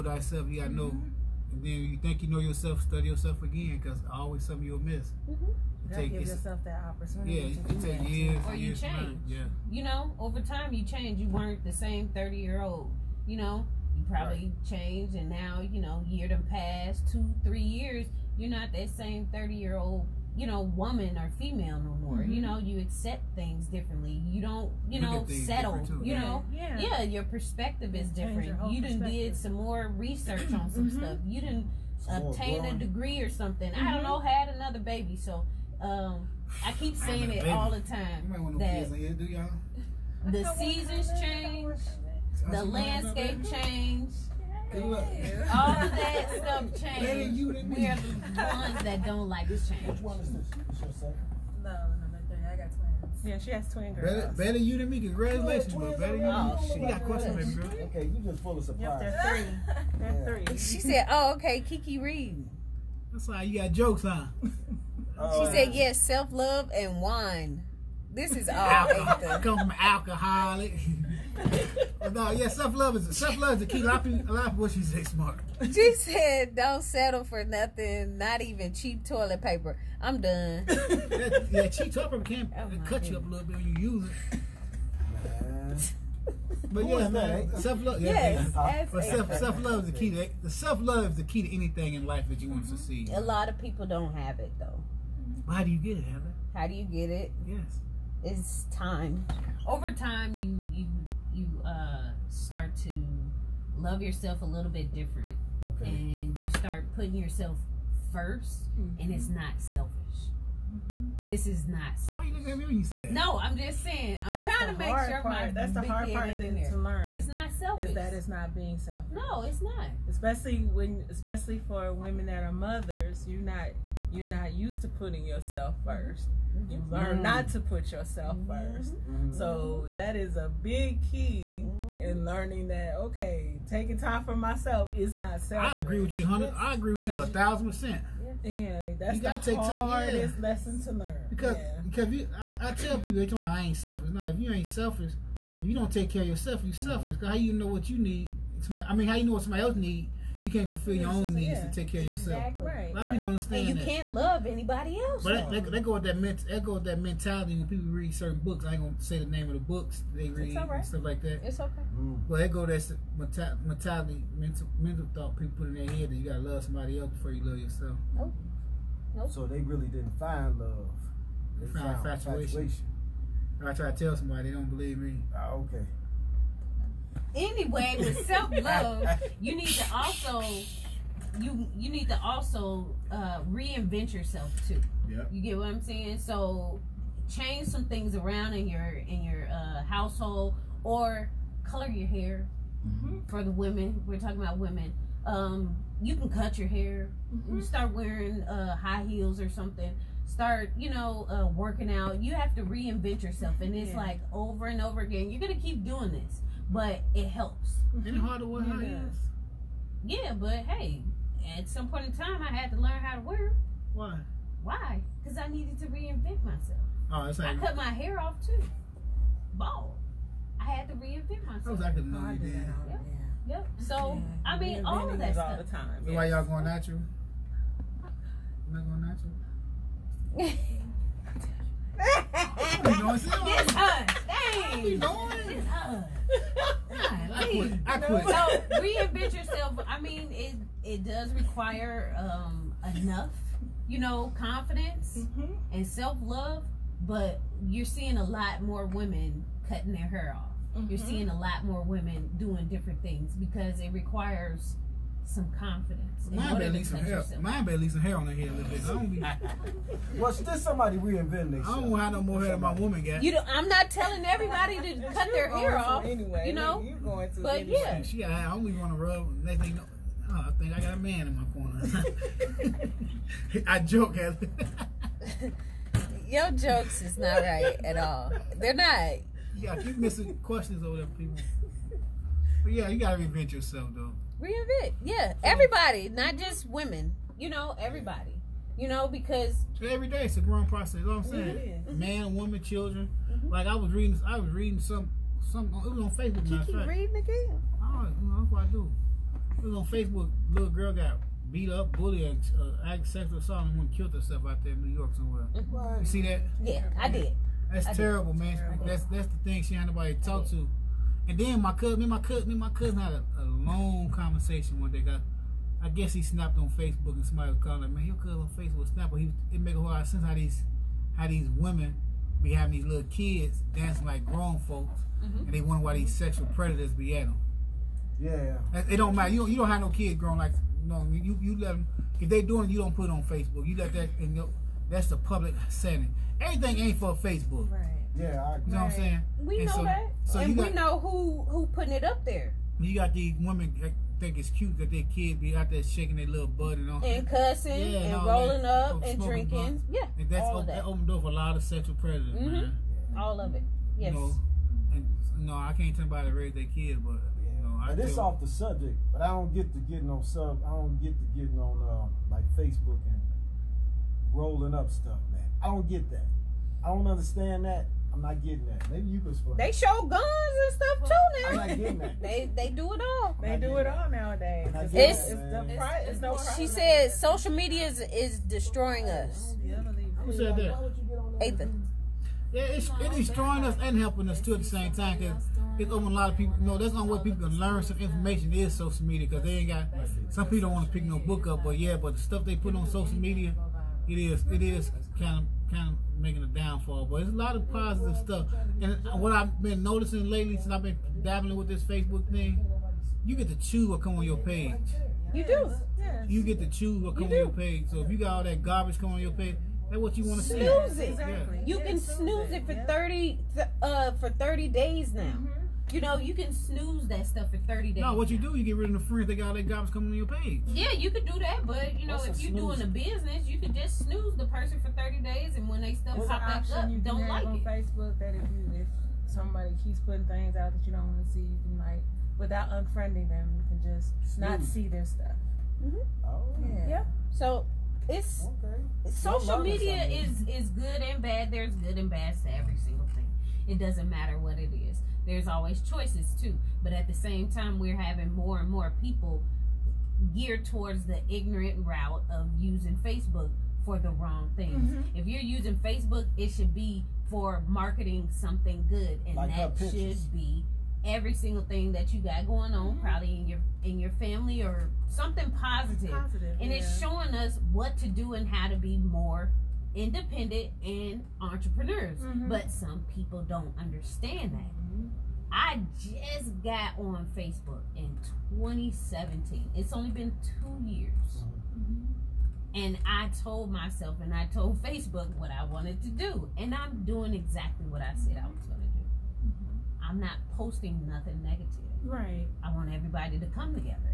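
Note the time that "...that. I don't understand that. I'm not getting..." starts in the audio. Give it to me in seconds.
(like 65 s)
366 s.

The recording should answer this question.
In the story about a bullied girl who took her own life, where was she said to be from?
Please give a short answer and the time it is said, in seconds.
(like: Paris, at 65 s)
New York, at 304 s.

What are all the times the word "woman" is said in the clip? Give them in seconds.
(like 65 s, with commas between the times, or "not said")
20 s, 262 s, 292 s.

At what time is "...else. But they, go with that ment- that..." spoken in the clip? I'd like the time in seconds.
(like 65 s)
154 s.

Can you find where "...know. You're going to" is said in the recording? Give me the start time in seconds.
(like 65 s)
266 s.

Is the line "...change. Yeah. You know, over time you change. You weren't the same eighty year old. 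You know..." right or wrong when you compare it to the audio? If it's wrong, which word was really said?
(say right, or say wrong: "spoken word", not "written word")
wrong: "thirty", not "eighty".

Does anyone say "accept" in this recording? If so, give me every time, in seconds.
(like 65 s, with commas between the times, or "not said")
22 s.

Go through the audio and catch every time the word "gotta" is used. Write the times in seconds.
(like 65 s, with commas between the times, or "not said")
0 s, 139 s, 166 s, 282 s.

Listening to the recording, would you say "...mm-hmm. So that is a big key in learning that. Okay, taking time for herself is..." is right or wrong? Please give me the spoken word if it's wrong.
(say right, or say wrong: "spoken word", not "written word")
wrong: "myself", not "herself".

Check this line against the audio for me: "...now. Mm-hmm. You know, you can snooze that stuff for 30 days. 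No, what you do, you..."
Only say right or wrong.
right.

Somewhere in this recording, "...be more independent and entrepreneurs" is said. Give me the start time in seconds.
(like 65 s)
468 s.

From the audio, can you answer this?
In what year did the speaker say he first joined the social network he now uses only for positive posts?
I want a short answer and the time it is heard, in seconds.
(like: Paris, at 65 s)
2017, at 478 s.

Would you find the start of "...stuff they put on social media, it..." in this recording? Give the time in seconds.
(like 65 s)
392 s.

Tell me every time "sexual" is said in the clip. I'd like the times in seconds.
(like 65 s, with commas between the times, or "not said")
303 s, 326 s, 351 s.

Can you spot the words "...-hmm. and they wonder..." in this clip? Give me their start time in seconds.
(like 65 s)
325 s.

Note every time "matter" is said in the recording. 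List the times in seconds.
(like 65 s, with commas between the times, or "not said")
329 s, 444 s.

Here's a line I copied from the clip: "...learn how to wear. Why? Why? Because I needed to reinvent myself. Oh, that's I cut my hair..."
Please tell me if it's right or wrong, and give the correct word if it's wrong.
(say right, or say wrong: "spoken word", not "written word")
right.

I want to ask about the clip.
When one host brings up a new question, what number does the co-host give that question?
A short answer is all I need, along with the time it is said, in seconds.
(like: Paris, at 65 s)
3, at 52 s.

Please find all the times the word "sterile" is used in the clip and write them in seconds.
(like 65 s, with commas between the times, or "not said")
not said.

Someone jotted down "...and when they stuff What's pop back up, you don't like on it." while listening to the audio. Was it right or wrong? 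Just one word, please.
right.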